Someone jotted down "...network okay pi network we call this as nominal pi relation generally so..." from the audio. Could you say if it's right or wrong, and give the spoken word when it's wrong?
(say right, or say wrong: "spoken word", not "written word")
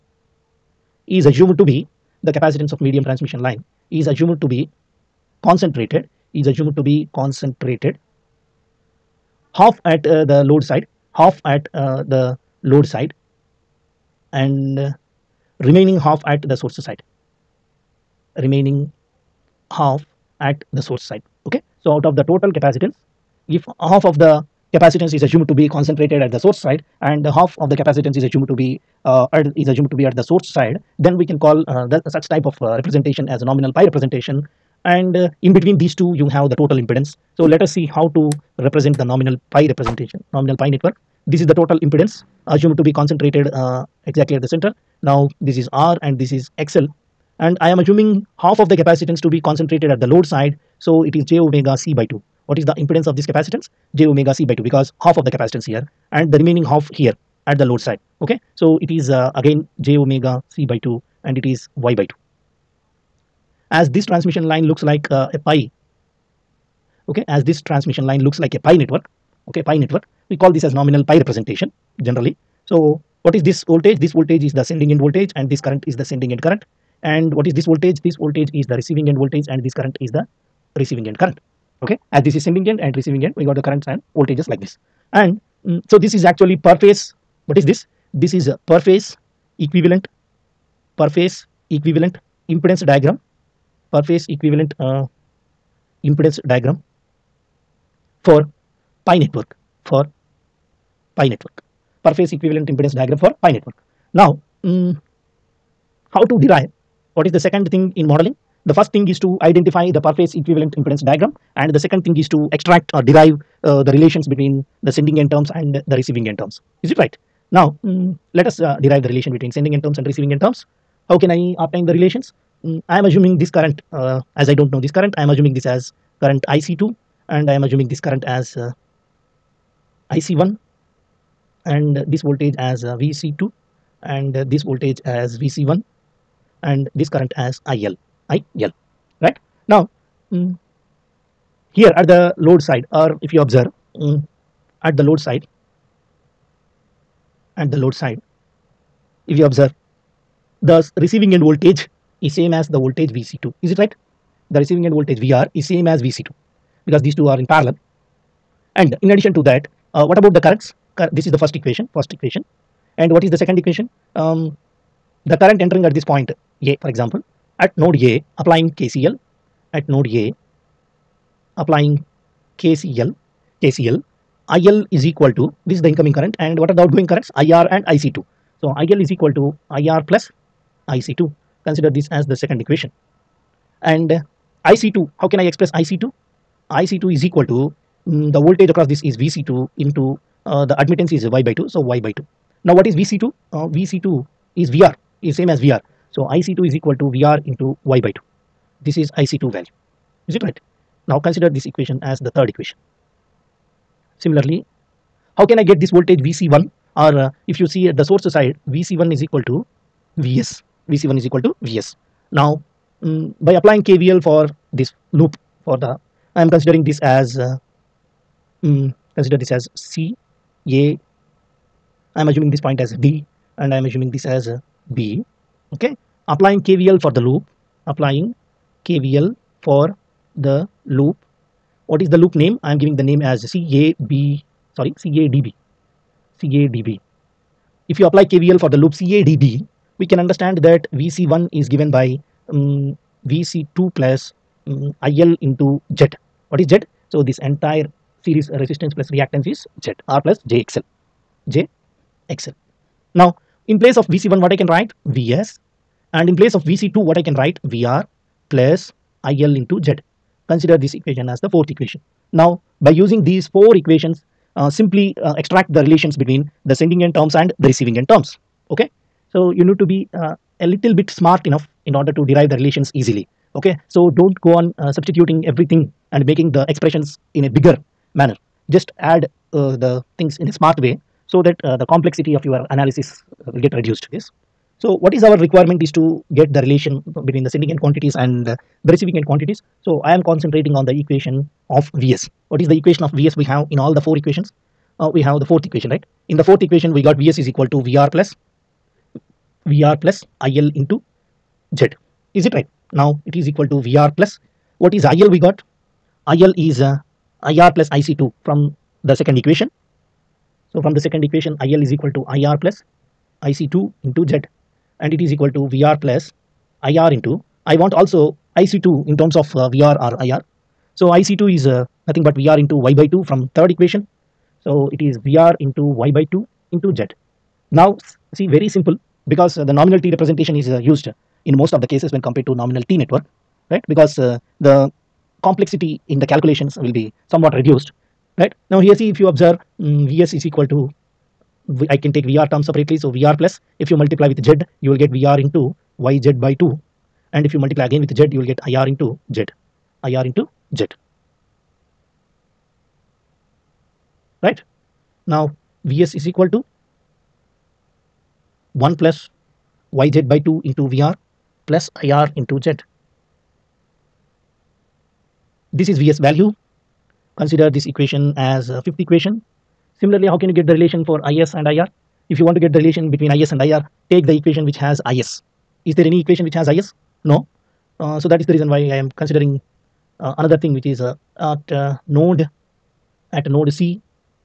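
wrong: "representation", not "relation".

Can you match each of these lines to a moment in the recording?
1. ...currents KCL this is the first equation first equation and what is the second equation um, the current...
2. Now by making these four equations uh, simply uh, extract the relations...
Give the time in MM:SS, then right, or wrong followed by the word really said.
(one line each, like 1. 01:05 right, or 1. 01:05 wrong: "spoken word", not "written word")
1. 02:40 wrong: "Cur", not "KCL"
2. 04:22 wrong: "using", not "making".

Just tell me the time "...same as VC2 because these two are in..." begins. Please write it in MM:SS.
02:35.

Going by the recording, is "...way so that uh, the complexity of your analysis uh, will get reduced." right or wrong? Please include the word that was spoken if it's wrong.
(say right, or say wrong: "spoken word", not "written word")
right.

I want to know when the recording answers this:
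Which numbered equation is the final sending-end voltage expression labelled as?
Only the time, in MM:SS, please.
06:08.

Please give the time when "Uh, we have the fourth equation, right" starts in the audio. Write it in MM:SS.
04:54.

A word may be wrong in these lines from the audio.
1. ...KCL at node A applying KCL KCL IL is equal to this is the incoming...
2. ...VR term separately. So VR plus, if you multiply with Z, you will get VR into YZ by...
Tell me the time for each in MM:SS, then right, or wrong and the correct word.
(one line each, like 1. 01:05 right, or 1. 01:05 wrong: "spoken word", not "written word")
1. 02:48 right
2. 05:42 right.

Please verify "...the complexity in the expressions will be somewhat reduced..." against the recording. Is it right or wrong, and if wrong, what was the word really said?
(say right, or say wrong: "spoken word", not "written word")
wrong: "calculations", not "expressions".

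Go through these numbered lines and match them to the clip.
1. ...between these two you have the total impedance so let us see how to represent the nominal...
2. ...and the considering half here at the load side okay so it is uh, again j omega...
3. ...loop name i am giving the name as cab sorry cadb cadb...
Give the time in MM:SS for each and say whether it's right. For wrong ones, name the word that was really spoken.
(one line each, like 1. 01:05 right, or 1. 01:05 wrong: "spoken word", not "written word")
1. 00:35 right
2. 00:56 wrong: "remaining", not "considering"
3. 03:52 right.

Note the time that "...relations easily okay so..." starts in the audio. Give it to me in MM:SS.
04:32.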